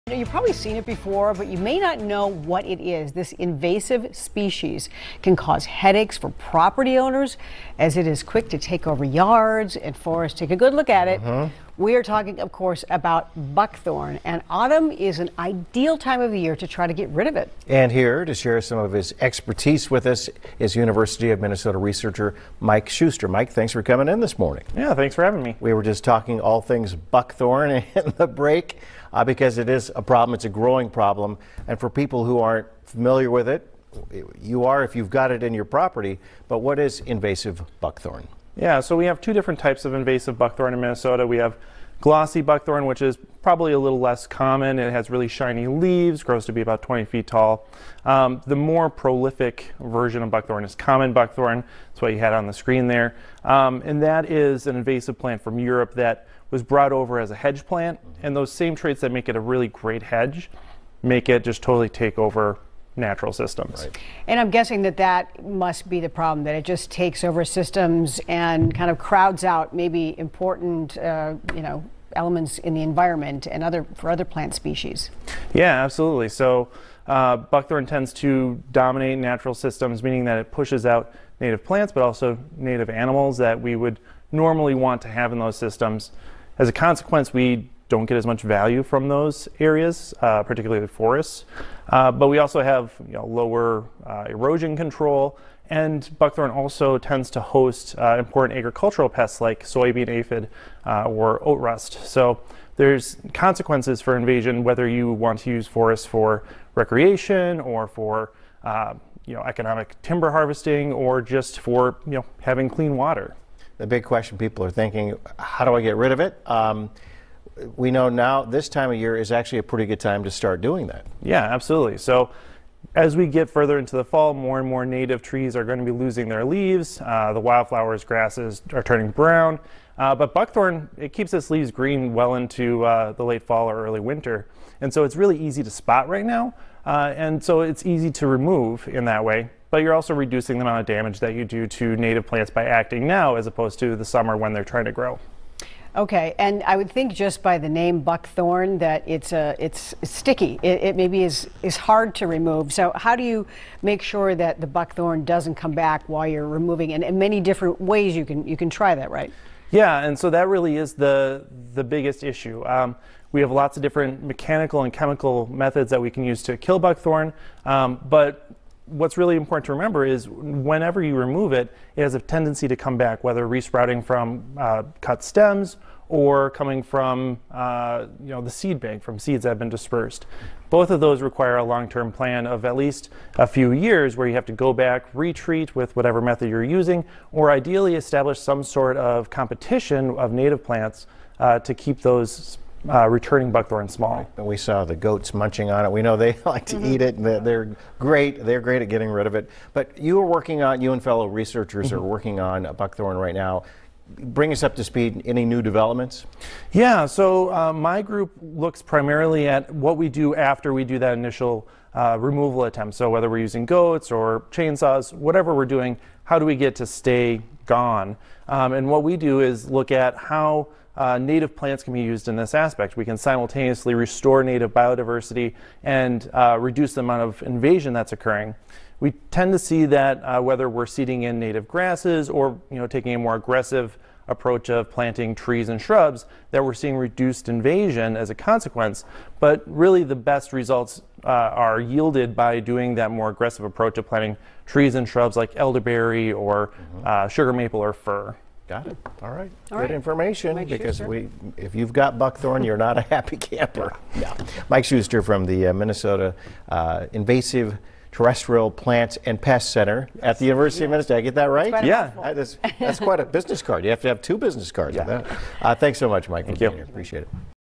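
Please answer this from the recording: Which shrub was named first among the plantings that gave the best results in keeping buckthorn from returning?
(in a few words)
elderberry.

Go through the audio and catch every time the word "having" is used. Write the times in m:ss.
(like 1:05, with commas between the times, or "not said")
0:25, 1:52.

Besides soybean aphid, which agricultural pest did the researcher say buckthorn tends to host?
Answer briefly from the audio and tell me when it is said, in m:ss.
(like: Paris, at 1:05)
oat rust, at 1:41.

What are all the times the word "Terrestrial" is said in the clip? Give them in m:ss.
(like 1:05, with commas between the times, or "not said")
4:18.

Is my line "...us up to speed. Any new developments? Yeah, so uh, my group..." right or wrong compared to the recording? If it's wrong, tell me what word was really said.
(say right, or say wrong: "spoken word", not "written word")
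right.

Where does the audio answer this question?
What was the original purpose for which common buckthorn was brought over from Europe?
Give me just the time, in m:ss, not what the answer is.
0:57.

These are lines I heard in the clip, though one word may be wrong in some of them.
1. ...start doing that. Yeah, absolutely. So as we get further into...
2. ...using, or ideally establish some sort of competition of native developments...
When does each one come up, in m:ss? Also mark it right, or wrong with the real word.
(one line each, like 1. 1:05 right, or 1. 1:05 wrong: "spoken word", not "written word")
1. 2:00 right
2. 3:06 wrong: "plants", not "developments".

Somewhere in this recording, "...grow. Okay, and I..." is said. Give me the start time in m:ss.
2:24.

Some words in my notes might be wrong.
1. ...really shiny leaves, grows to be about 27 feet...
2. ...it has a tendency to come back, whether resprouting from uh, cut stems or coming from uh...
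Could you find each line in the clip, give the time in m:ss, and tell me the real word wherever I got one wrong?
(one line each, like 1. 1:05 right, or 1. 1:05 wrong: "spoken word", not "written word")
1. 0:45 wrong: "20", not "27"
2. 2:51 right.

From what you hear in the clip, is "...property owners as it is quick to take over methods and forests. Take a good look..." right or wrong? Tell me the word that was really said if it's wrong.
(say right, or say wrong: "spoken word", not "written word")
wrong: "yards", not "methods".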